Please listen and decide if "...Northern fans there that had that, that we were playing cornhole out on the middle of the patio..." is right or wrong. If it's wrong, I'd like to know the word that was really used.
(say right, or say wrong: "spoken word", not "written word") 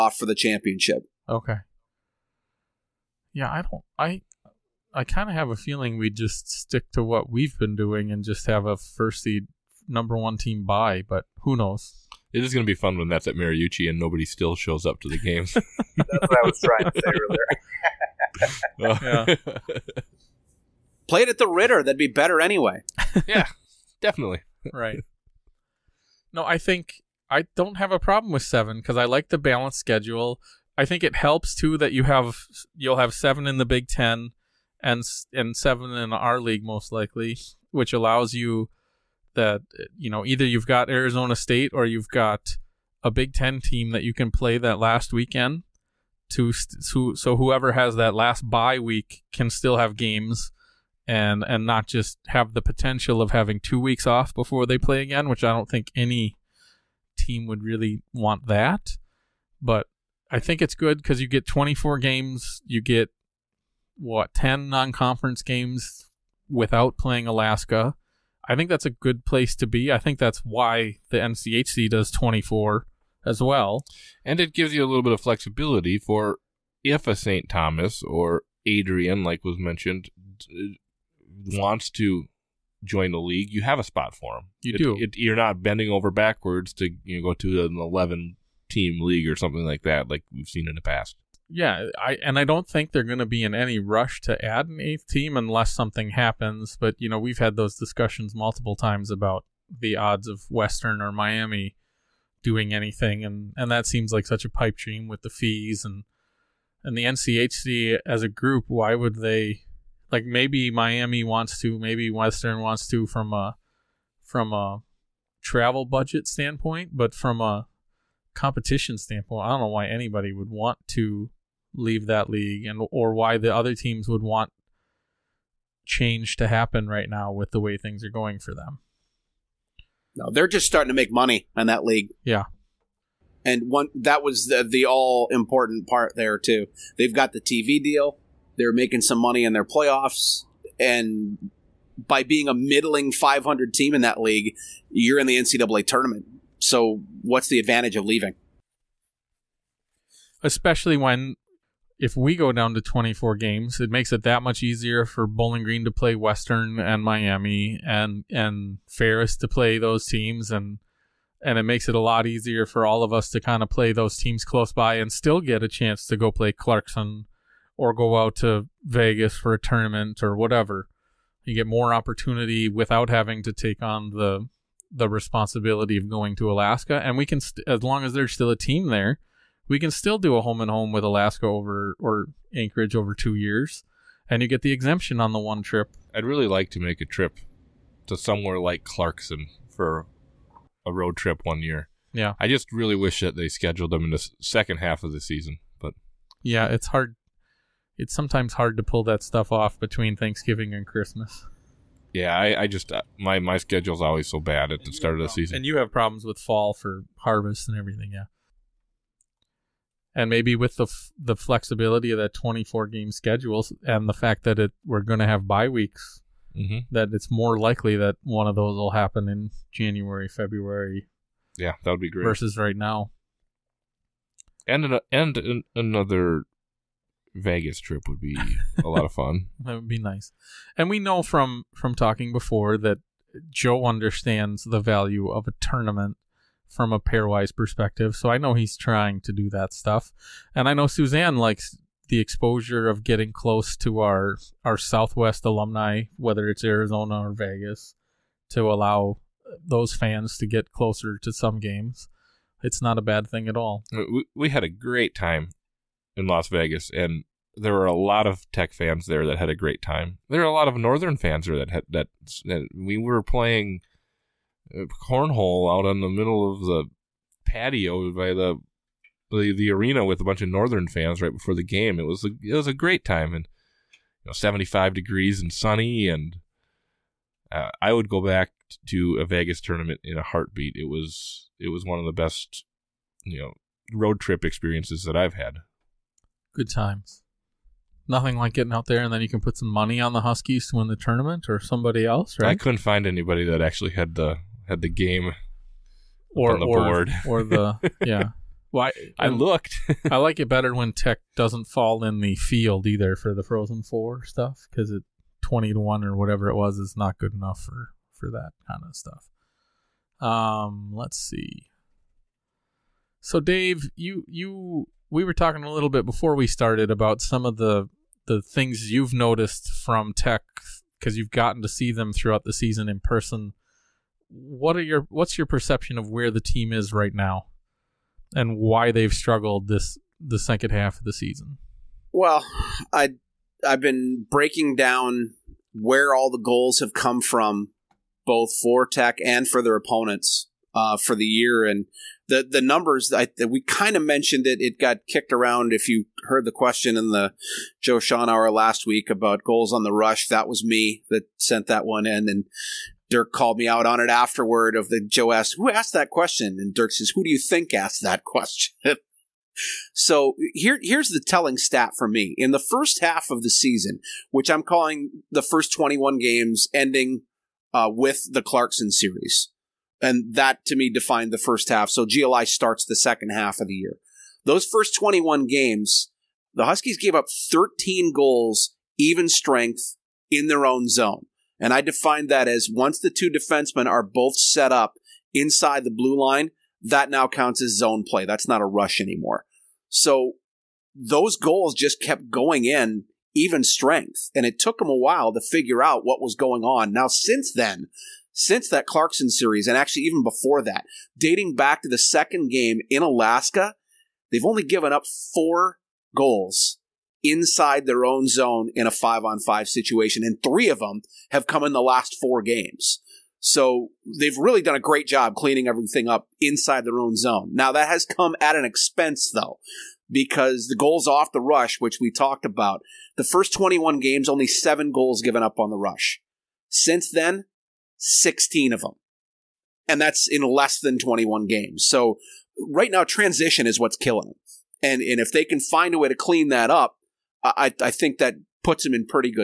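right.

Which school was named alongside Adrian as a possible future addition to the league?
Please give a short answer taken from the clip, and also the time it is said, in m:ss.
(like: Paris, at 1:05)
St. Thomas, at 1:17.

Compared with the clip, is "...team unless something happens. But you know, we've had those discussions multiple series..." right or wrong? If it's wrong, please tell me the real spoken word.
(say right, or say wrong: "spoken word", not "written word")
wrong: "times", not "series".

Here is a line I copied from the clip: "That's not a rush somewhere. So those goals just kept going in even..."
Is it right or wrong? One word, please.
wrong.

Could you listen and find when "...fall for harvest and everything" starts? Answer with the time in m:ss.
3:26.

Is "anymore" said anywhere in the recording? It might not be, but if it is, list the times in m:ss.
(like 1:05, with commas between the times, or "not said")
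6:28.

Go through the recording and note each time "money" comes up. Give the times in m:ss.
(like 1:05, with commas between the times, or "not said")
2:11, 2:19, 4:49.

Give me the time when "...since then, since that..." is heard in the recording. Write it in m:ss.
6:37.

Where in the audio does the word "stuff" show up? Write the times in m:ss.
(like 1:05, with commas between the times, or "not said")
3:19, 3:59, 5:04, 5:08.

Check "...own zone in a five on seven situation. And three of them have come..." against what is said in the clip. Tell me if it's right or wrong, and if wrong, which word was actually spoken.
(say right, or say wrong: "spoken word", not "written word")
wrong: "five", not "seven".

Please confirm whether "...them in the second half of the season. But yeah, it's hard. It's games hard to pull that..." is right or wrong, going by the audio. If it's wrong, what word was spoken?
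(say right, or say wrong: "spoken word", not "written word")
wrong: "sometimes", not "games".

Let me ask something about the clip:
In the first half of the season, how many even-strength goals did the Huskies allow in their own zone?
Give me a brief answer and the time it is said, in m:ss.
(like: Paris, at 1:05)
13, at 6:17.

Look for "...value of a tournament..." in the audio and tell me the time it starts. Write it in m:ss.
3:54.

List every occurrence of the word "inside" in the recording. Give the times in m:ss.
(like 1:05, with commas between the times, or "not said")
6:25, 6:47, 6:56.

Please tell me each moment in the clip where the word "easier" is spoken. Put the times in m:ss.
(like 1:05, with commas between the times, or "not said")
2:34, 2:42.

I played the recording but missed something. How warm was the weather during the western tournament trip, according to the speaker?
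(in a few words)
75 degrees.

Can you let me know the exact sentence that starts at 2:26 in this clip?
So what's the advantage of leaving?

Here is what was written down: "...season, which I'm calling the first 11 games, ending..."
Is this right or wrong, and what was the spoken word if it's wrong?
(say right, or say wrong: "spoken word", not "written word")
wrong: "21", not "11".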